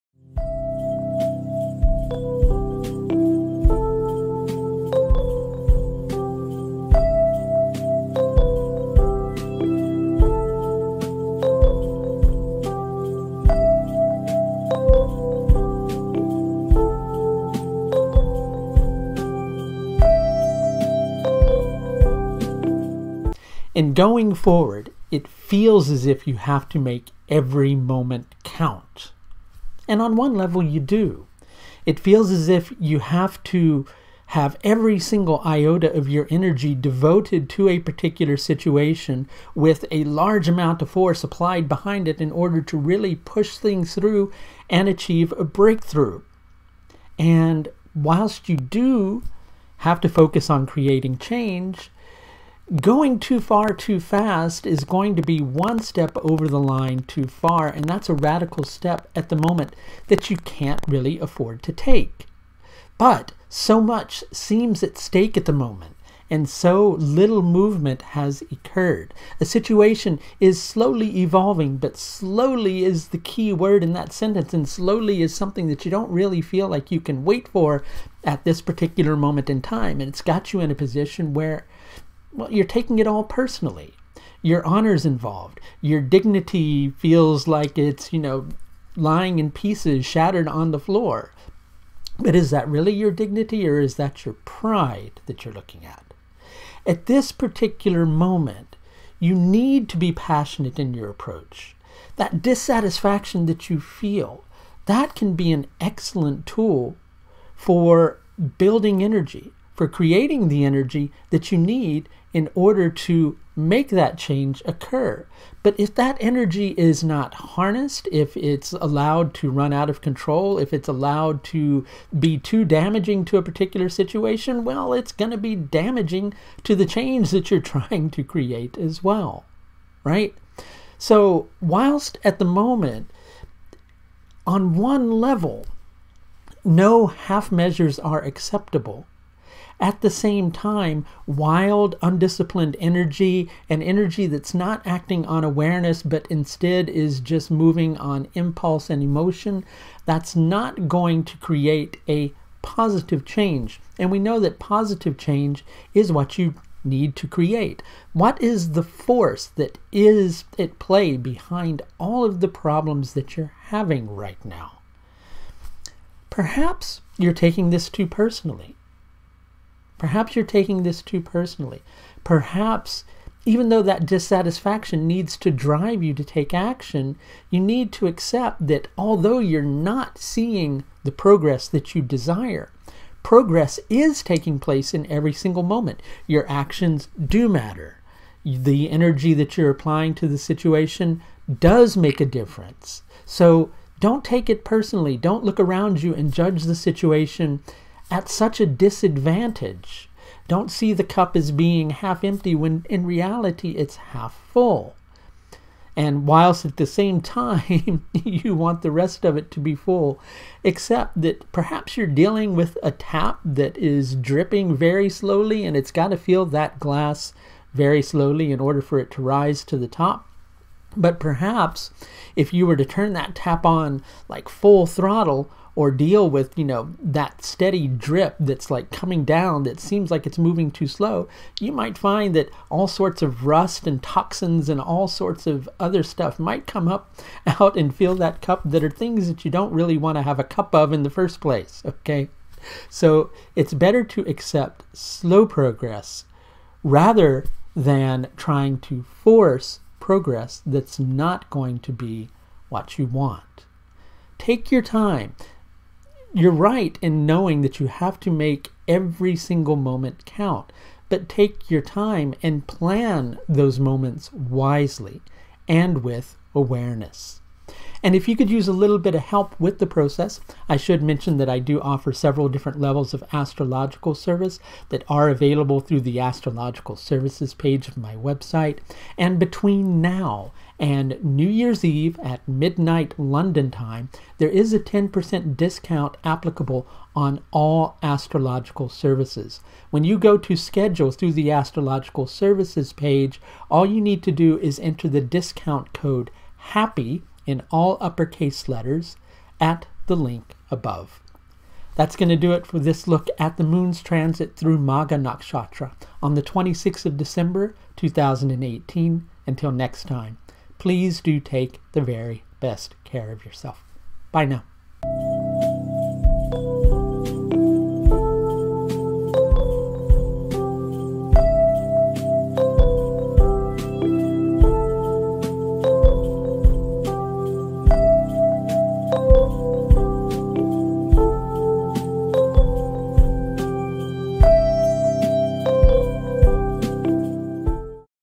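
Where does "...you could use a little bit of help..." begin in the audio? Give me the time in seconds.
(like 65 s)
268 s.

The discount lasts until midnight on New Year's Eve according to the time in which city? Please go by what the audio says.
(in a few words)
London.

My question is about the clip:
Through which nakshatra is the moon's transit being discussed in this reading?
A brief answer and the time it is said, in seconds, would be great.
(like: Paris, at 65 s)
Magha, at 304 s.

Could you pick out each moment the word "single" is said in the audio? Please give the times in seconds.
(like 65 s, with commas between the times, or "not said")
34 s, 185 s, 259 s.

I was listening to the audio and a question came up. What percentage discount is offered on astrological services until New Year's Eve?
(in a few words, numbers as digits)
10%.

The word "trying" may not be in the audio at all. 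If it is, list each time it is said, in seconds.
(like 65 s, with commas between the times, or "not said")
127 s, 248 s.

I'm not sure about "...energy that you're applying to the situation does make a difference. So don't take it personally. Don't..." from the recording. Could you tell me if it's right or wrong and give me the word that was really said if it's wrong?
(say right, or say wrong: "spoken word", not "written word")
right.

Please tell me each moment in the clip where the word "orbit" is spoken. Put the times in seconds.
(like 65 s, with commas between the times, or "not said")
not said.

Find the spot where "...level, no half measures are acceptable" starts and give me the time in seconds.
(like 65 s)
135 s.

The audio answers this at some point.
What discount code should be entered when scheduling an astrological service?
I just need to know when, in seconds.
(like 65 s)
296 s.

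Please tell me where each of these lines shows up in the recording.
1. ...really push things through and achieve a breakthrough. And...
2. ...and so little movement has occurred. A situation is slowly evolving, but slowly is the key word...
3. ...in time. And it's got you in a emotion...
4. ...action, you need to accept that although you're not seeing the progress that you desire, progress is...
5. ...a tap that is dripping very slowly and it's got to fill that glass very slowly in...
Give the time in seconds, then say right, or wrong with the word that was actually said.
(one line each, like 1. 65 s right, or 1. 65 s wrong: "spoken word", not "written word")
1. 42 s right
2. 66 s right
3. 79 s wrong: "position", not "emotion"
4. 176 s right
5. 212 s right.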